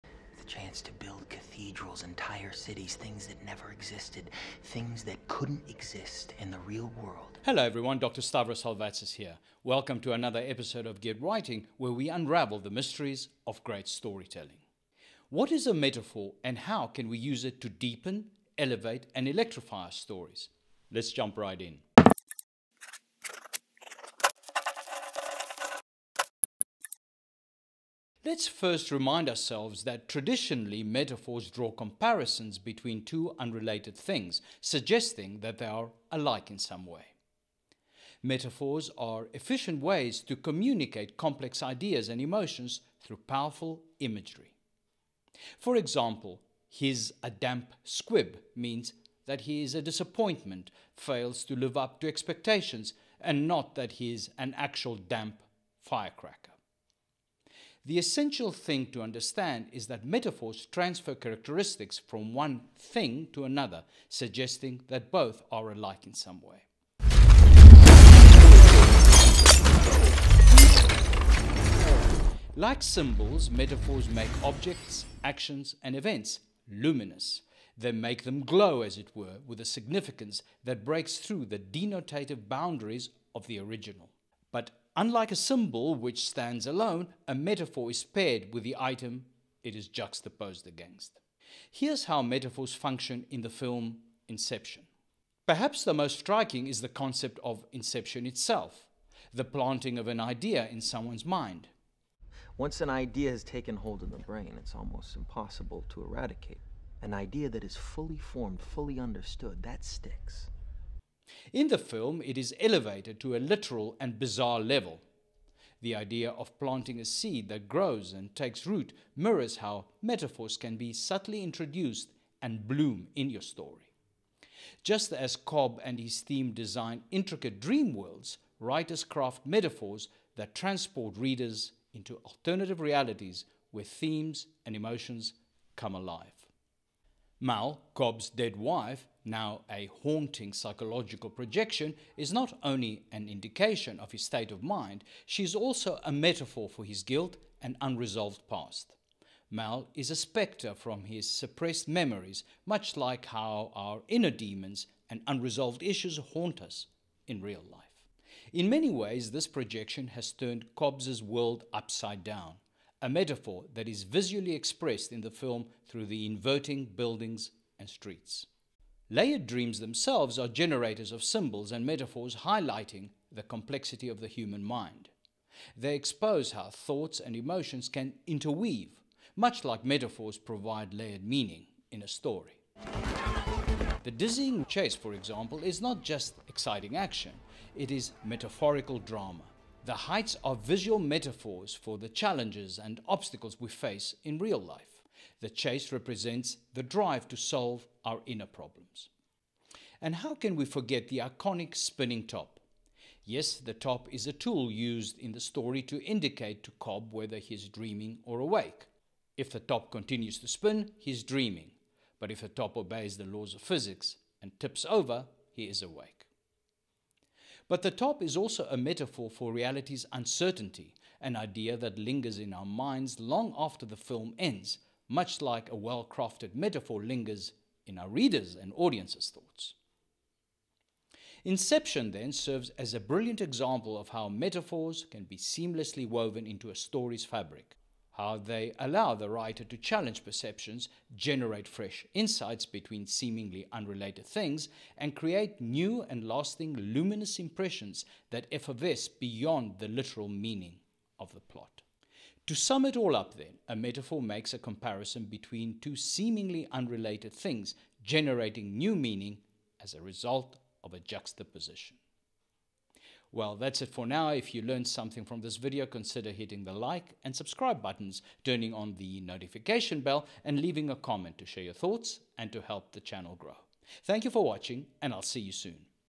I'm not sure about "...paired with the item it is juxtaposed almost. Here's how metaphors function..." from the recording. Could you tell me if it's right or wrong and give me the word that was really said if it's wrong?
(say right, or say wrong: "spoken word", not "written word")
wrong: "against", not "almost".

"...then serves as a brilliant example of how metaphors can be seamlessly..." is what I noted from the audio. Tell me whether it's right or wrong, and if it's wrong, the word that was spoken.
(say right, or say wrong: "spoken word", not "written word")
right.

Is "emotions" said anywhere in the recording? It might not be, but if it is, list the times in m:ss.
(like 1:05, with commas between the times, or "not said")
0:42, 2:14, 2:57.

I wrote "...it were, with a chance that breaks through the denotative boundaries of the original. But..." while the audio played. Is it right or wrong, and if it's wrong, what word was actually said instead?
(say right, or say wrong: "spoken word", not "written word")
wrong: "significance", not "chance".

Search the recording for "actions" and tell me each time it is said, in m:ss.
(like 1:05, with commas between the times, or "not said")
1:15, 3:06.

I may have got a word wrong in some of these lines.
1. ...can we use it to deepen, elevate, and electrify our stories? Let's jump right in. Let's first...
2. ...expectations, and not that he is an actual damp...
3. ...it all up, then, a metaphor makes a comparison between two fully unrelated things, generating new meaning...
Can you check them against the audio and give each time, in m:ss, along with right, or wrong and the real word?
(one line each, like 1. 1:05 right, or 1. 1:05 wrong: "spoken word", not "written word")
1. 0:16 right
2. 0:52 right
3. 4:12 wrong: "seemingly", not "fully".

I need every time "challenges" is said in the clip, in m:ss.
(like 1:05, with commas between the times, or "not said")
3:12, 3:59.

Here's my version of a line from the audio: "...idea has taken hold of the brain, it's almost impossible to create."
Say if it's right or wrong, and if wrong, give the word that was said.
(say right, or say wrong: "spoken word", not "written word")
wrong: "eradicate", not "create".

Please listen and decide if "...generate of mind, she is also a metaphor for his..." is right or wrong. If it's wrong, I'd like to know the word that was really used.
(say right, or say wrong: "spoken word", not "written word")
wrong: "state", not "generate".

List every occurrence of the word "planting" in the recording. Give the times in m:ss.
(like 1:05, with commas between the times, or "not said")
1:39, 1:56.